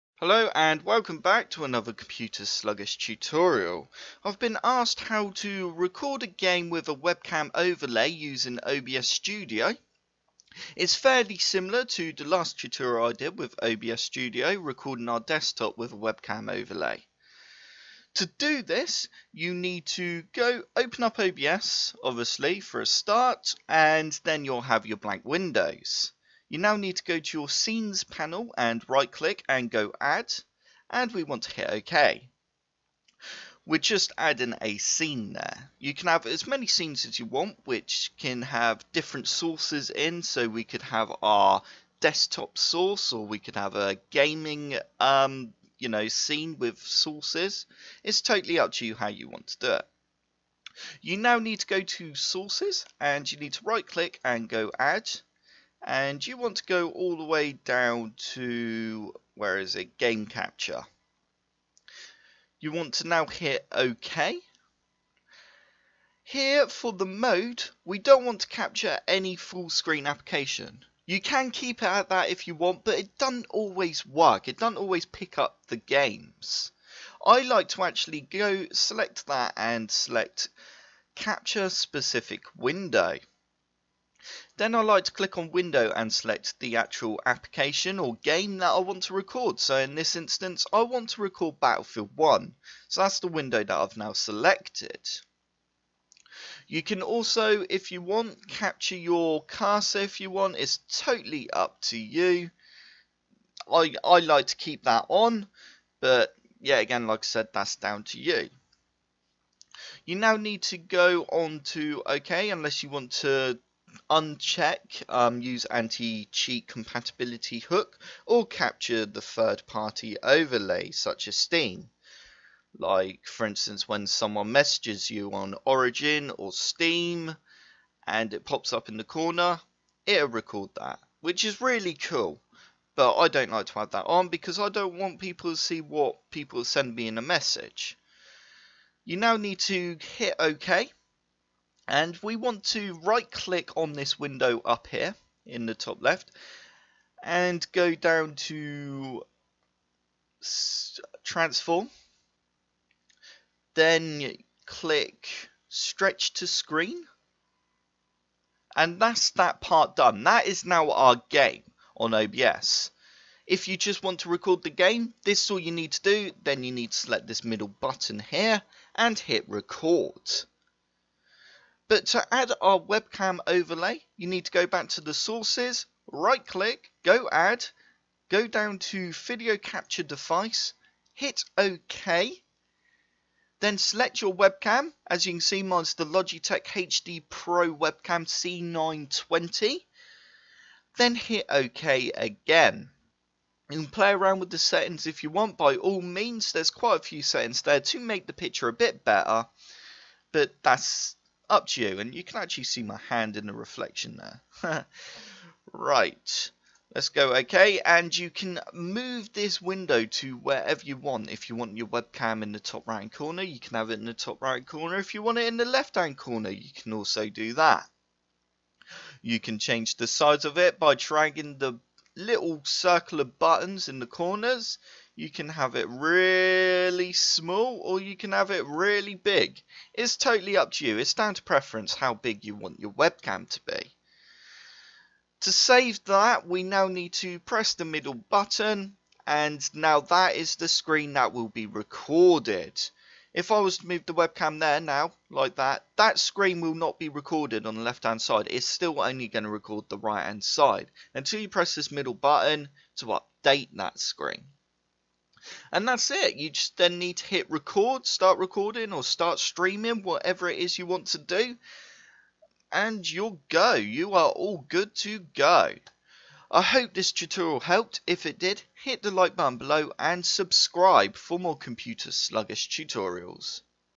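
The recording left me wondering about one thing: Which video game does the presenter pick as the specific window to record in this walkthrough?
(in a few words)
Battlefield 1.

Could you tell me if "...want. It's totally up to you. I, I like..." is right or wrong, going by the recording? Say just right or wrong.
right.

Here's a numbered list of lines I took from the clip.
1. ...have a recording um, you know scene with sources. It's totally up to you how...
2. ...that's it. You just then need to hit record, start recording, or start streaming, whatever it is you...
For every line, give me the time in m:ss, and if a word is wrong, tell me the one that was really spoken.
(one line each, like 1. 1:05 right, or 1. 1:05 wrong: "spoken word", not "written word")
1. 0:43 wrong: "gaming", not "recording"
2. 4:15 right.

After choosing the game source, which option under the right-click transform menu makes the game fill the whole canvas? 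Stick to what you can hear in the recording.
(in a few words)
Stretch to screen.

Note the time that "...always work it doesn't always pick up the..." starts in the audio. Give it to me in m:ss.
1:13.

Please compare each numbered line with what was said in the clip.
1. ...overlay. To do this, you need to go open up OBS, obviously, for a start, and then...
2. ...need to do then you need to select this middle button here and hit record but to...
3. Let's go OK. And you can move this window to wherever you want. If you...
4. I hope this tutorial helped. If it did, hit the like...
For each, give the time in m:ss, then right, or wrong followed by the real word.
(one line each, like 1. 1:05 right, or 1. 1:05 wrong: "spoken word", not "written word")
1. 0:16 right
2. 2:45 right
3. 3:26 right
4. 4:26 right.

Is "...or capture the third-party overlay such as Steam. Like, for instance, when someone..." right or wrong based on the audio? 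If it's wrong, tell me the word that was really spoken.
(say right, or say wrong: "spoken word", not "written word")
right.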